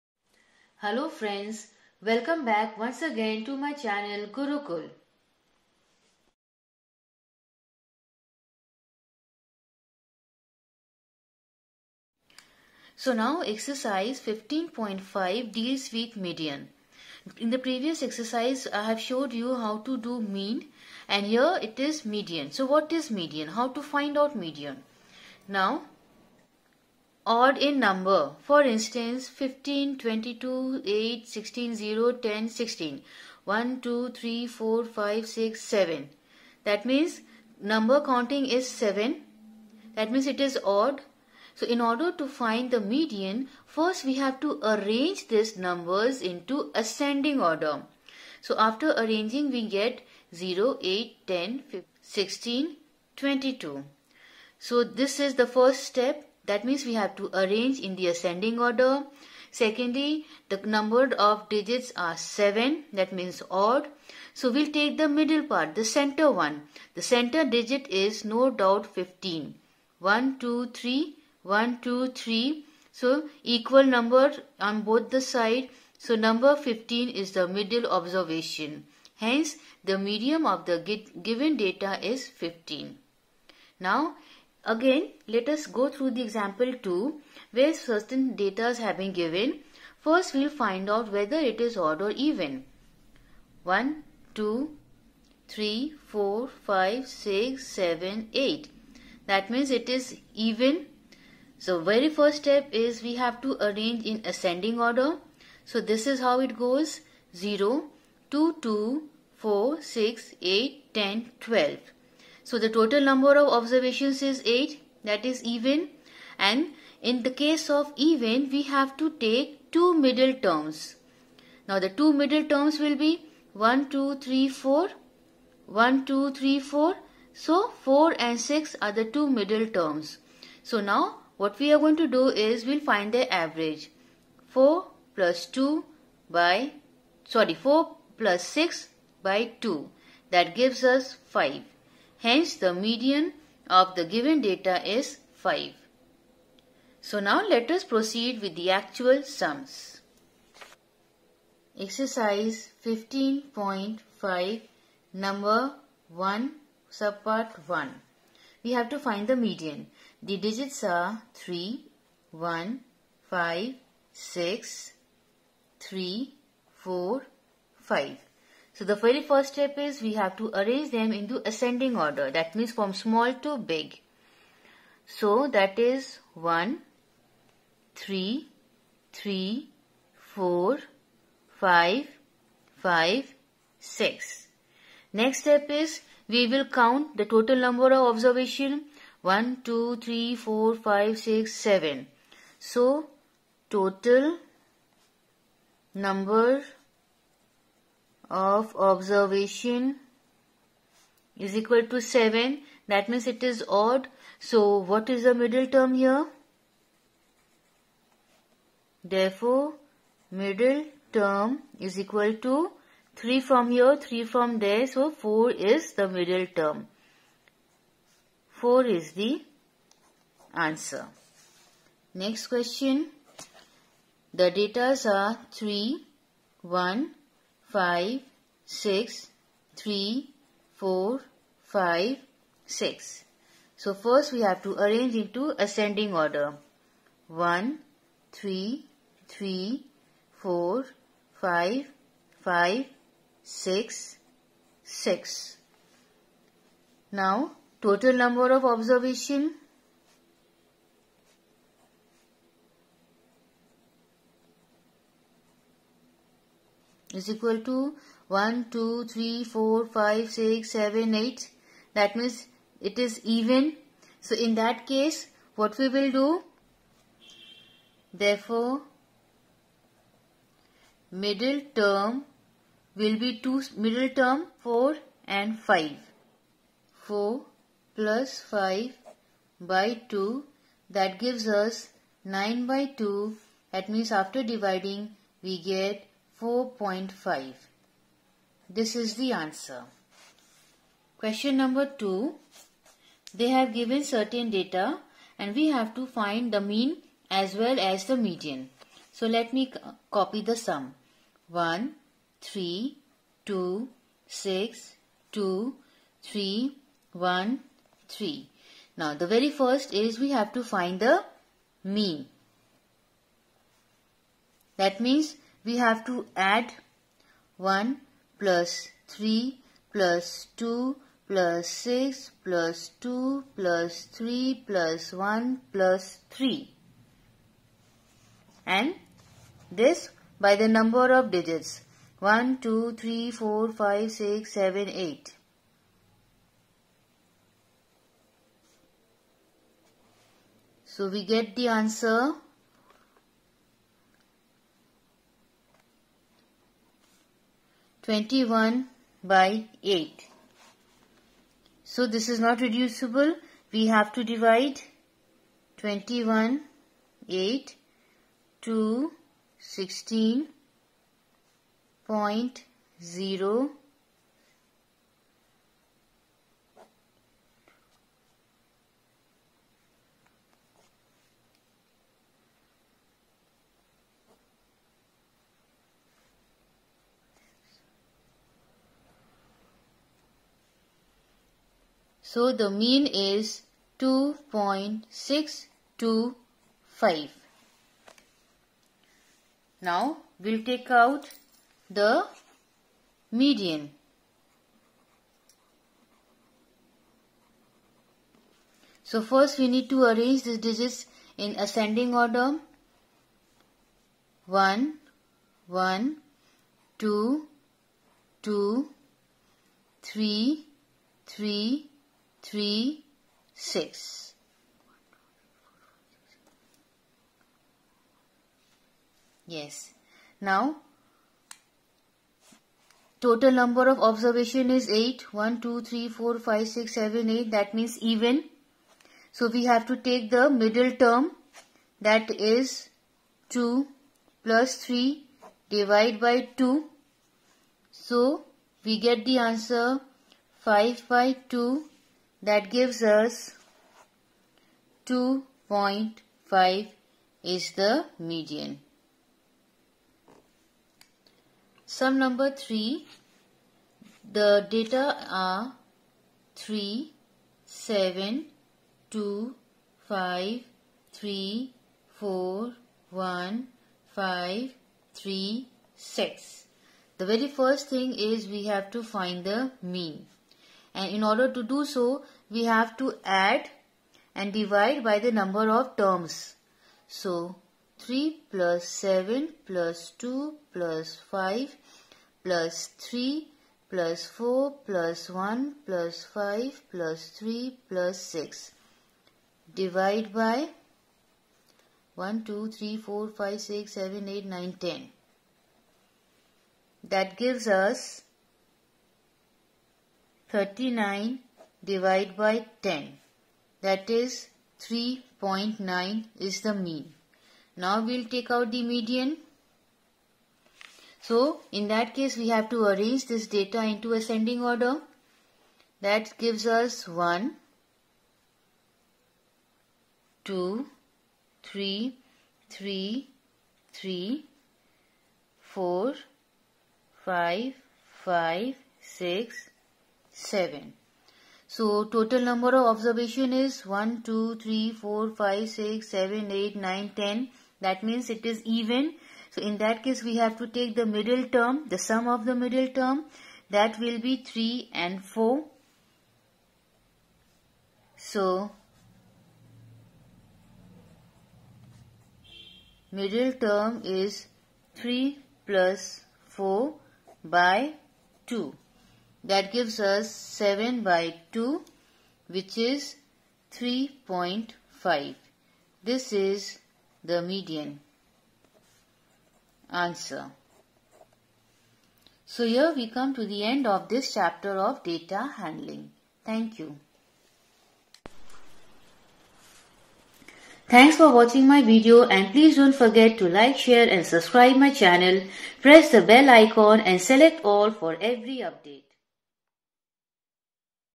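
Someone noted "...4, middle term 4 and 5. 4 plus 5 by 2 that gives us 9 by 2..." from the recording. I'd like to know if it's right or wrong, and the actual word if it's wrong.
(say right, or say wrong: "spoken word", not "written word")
wrong: "2", not "4".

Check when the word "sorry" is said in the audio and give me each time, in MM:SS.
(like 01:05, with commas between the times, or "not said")
02:17.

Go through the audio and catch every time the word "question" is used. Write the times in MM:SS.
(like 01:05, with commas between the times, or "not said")
03:42, 04:51.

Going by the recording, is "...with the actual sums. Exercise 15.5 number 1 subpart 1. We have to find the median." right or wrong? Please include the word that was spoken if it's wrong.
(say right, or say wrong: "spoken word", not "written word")
right.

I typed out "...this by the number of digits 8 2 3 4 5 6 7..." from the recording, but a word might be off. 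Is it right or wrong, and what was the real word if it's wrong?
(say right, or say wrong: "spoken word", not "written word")
wrong: "1", not "8".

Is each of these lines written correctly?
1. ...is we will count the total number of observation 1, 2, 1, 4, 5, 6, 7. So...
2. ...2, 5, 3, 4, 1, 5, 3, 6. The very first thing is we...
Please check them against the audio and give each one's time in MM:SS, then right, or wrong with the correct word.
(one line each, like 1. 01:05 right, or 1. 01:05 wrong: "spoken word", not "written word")
1. 03:05 wrong: "3", not "1"
2. 07:39 right.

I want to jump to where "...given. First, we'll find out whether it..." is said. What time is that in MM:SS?
01:29.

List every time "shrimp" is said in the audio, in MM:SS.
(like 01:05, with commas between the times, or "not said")
not said.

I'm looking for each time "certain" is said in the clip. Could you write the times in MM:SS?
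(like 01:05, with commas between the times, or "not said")
01:27, 04:54.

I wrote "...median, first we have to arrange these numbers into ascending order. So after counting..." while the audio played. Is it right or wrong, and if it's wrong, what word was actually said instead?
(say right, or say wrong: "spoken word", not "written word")
wrong: "arranging", not "counting".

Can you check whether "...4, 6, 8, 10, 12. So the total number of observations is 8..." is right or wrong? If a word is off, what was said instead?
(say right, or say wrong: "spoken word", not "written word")
right.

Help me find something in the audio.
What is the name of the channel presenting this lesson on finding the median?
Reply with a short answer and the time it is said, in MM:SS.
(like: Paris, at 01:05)
Gurukul, at 00:04.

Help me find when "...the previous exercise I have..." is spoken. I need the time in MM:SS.
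00:17.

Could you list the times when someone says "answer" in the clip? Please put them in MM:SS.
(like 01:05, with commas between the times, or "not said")
03:40, 04:49, 05:41, 07:19, 09:29.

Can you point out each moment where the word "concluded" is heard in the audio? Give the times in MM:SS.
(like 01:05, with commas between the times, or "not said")
not said.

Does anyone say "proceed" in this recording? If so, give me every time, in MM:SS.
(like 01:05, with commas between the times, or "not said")
02:27.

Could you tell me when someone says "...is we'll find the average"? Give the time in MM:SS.
02:12.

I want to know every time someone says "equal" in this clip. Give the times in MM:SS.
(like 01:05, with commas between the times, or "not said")
01:13, 03:21, 03:31, 04:17.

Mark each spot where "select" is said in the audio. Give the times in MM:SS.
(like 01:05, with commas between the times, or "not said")
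09:47.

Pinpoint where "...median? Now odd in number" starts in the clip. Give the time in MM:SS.
00:24.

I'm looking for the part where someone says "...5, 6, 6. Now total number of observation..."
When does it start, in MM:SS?
04:02.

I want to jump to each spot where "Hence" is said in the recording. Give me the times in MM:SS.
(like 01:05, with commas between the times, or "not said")
01:19, 02:22.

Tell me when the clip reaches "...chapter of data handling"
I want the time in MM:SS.
09:34.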